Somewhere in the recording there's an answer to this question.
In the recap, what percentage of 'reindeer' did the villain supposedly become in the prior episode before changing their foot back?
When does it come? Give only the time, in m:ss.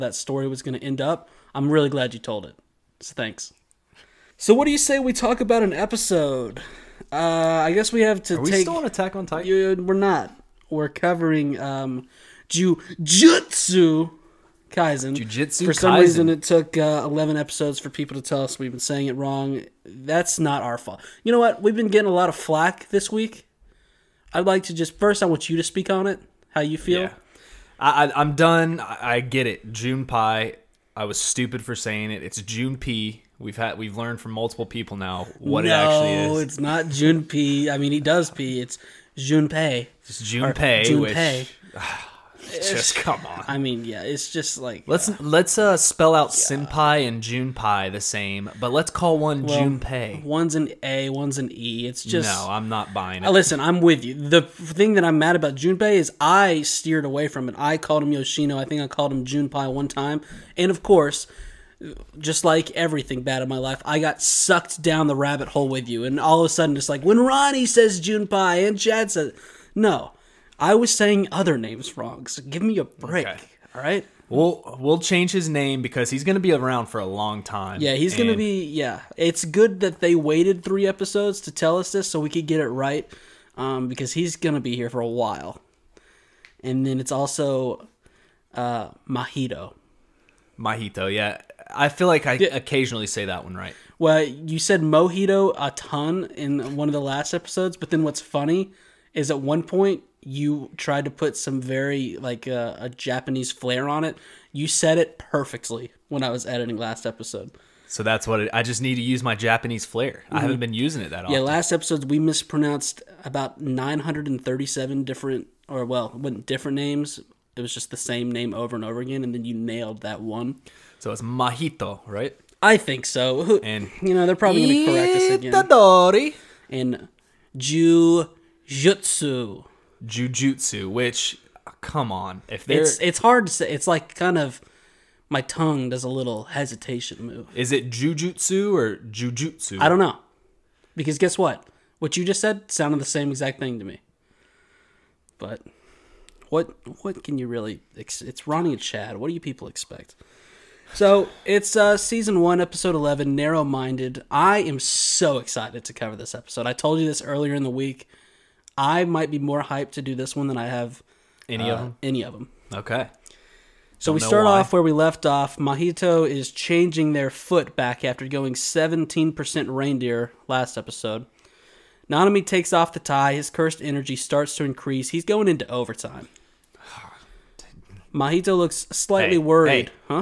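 2:48.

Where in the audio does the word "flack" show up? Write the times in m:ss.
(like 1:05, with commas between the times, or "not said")
0:22.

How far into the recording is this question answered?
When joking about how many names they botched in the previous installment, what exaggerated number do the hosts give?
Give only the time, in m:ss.
1:53.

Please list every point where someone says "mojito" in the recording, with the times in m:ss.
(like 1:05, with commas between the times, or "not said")
1:34.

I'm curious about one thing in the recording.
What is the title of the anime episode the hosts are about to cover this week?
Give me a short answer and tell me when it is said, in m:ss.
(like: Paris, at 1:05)
Narrow Minded, at 2:33.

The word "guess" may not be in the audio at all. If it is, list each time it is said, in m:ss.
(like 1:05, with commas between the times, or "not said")
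0:07, 2:21.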